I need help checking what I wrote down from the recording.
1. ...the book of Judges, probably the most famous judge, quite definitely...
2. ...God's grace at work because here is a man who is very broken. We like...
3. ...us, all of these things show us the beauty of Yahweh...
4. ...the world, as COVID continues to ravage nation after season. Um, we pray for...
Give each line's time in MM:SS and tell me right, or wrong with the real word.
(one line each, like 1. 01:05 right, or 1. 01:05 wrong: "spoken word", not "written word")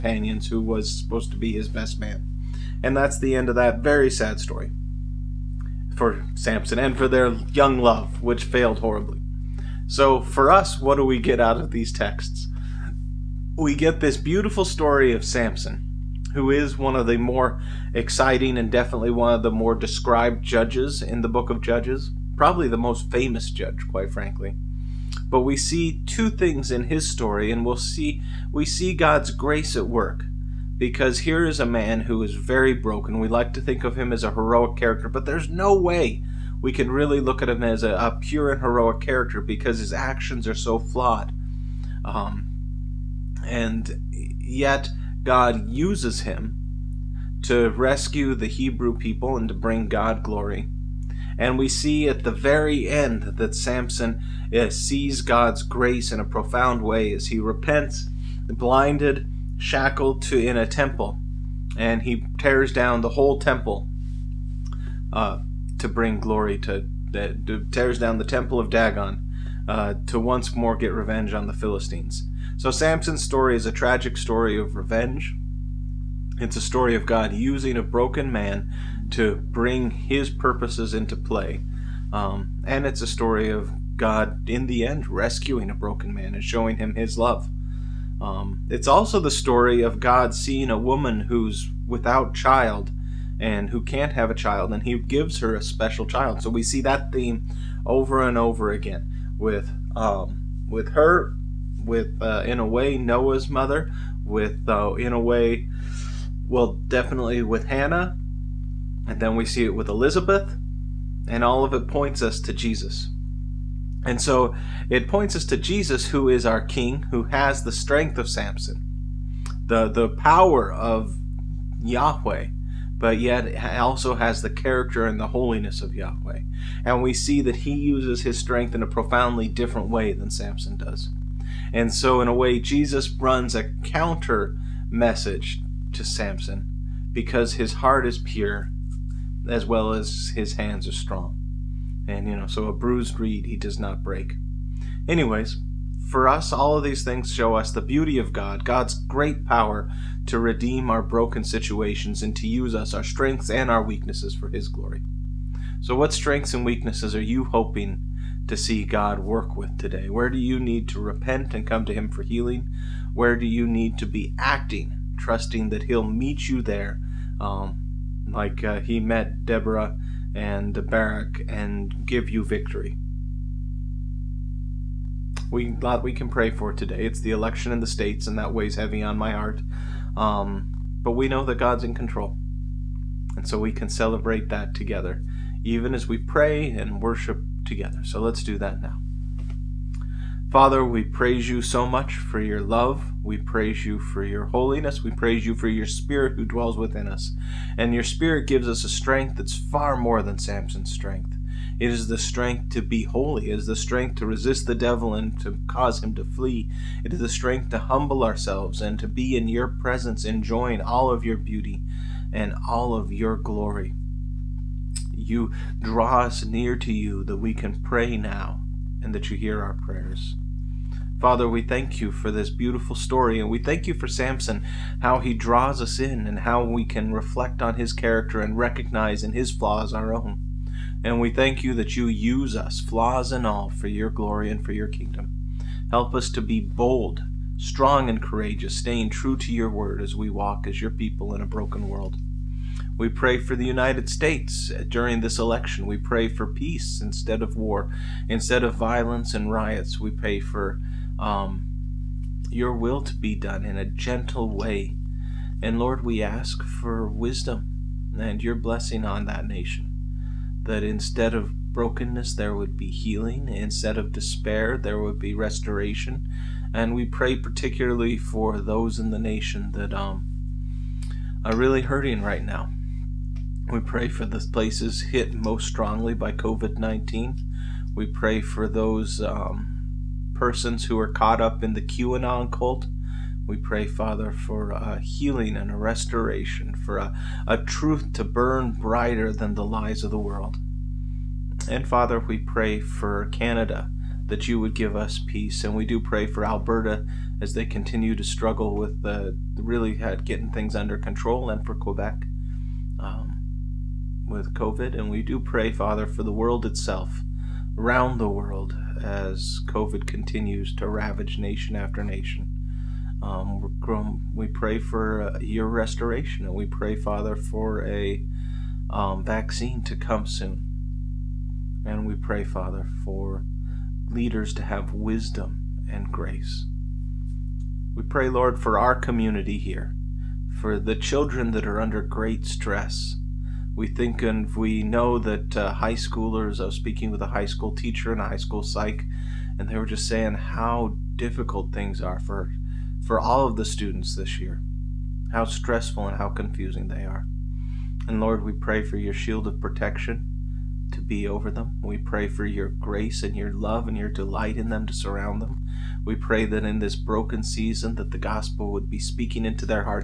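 1. 00:21 wrong: "frankly", not "definitely"
2. 00:28 right
3. 02:26 wrong: "God", not "Yahweh"
4. 05:08 wrong: "nation", not "season".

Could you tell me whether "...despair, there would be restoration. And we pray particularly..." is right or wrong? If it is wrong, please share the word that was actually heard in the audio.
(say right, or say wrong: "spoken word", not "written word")
right.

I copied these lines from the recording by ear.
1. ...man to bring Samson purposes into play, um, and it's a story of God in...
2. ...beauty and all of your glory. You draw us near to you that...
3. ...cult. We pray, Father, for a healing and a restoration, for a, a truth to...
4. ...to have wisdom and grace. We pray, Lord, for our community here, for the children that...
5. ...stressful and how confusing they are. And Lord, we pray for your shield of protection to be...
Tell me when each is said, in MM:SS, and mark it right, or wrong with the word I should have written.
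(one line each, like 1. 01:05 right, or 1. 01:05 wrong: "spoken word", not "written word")
1. 01:18 wrong: "His", not "Samson"
2. 03:31 right
3. 04:42 right
4. 05:24 right
5. 05:45 right.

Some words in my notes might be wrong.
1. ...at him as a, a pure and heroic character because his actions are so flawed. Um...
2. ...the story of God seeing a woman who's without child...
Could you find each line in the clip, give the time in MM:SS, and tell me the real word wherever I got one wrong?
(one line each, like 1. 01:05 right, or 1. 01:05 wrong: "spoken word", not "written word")
1. 00:37 right
2. 01:29 right.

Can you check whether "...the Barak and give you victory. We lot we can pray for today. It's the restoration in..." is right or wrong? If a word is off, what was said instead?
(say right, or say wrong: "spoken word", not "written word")
wrong: "election", not "restoration".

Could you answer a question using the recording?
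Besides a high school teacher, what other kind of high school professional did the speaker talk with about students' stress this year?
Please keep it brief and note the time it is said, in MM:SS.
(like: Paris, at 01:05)
High school psych, at 05:38.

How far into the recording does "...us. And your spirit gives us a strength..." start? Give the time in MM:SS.
03:17.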